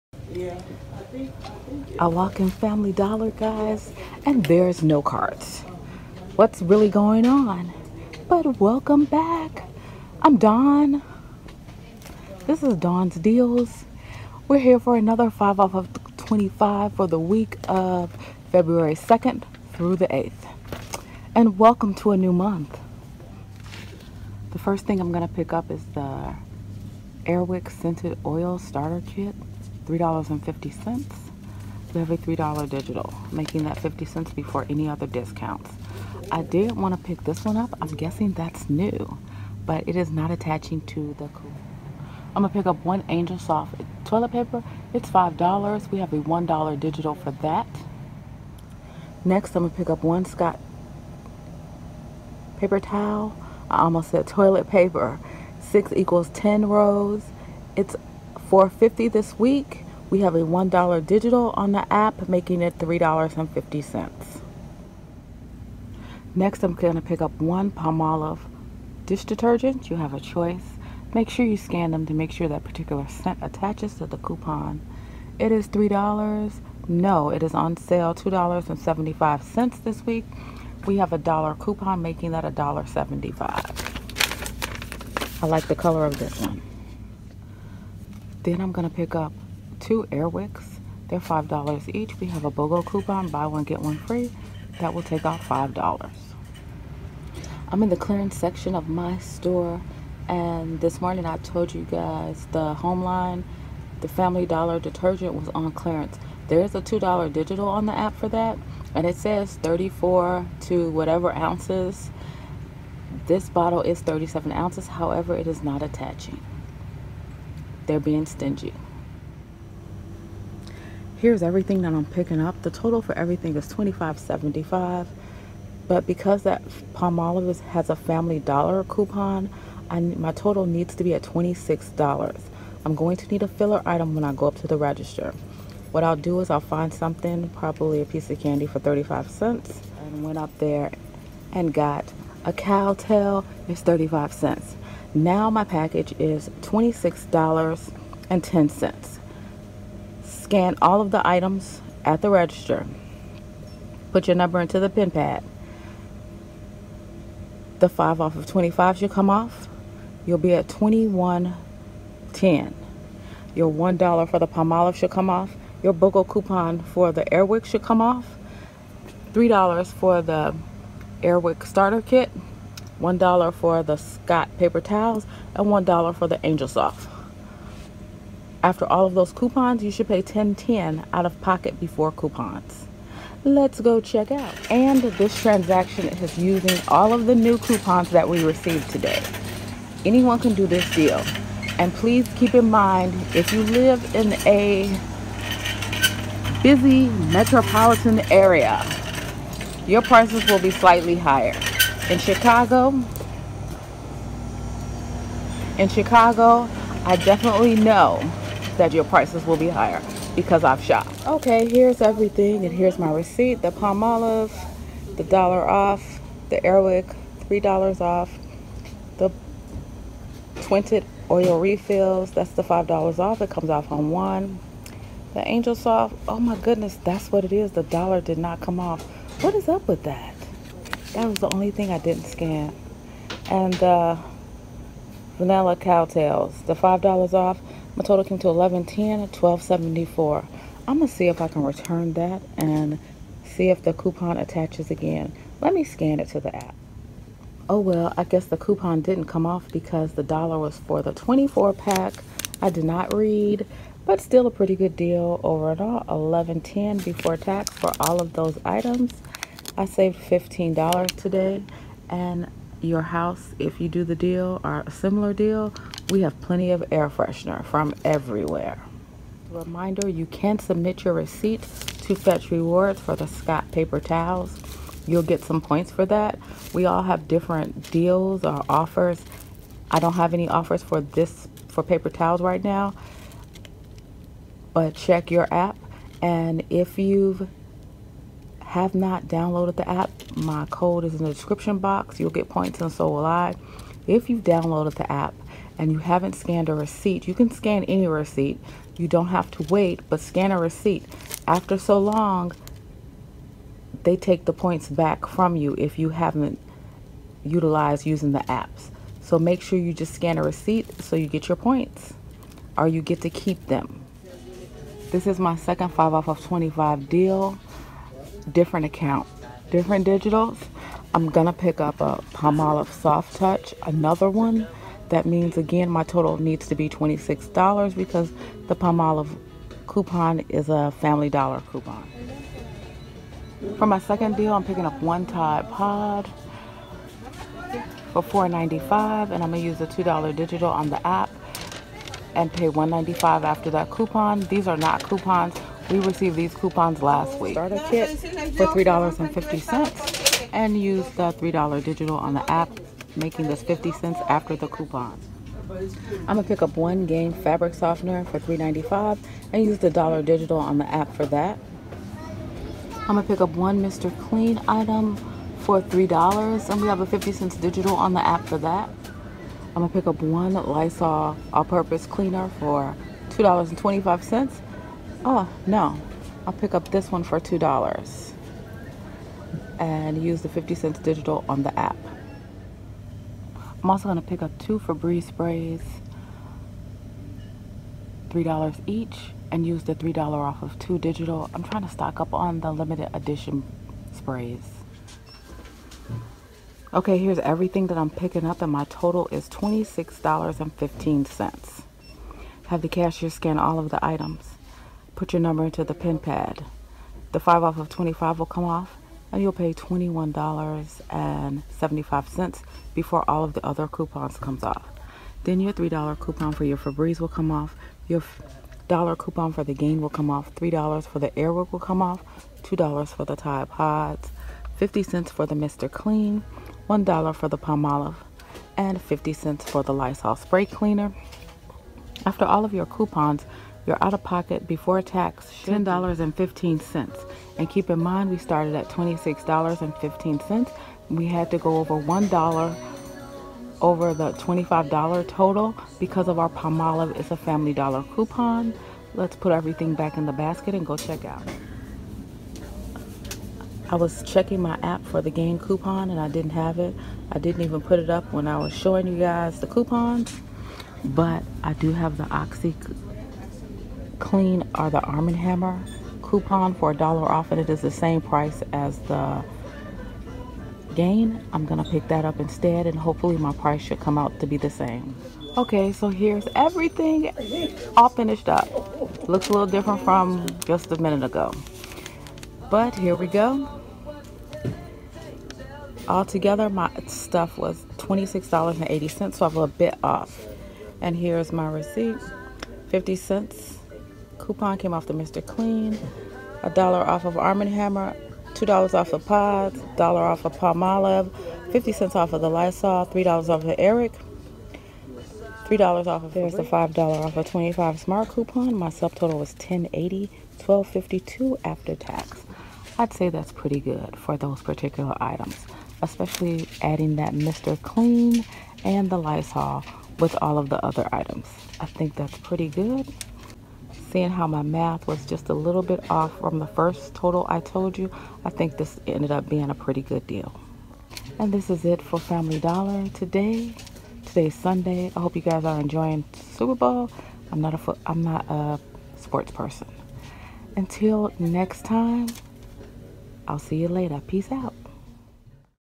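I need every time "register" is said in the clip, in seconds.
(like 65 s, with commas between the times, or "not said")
134 s, 152 s.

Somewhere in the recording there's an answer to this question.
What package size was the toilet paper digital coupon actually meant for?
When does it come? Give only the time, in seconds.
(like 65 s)
251 s.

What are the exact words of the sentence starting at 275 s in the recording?
You'll get some points for that.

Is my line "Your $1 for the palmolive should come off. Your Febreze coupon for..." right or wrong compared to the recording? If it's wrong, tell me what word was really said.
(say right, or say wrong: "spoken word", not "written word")
wrong: "BOGO", not "Febreze".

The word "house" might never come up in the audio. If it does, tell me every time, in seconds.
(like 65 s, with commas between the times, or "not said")
263 s.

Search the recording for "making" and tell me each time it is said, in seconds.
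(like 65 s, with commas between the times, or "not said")
33 s, 62 s, 82 s, 353 s.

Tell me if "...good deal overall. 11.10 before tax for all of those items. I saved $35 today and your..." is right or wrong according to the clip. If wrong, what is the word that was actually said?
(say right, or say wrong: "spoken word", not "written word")
wrong: "15", not "35".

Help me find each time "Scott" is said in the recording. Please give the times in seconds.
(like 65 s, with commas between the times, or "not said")
50 s, 173 s, 273 s.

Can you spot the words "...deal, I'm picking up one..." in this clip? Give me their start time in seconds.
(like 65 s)
334 s.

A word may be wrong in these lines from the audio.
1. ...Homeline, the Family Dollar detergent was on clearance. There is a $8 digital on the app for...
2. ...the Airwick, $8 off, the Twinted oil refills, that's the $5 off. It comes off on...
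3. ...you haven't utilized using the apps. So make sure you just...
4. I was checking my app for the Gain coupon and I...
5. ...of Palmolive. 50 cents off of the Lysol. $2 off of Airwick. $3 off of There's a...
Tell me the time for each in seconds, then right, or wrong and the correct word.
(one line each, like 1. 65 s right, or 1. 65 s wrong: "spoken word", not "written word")
1. 102 s wrong: "2", not "8"
2. 216 s wrong: "3", not "8"
3. 305 s right
4. 453 s right
5. 500 s wrong: "3", not "2".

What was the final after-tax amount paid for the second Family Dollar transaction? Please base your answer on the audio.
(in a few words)
$12.52.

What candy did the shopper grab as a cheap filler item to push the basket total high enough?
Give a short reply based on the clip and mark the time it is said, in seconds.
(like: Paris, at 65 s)
Cow Tale, at 142 s.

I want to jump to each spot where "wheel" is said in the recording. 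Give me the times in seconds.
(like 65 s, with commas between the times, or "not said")
not said.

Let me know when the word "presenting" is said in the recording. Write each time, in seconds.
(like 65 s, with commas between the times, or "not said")
not said.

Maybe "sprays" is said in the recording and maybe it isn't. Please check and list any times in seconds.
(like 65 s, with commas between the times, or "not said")
385 s, 394 s, 430 s.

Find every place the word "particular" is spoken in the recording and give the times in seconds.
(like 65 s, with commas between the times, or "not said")
72 s, 514 s.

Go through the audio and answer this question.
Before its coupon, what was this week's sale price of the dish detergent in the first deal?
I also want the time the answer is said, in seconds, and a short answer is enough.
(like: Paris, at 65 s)
$2.75, at 78 s.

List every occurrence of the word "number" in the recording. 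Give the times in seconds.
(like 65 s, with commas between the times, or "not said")
154 s, 405 s.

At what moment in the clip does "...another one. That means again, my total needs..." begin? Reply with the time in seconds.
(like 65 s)
323 s.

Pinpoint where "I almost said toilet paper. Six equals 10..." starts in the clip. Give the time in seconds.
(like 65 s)
53 s.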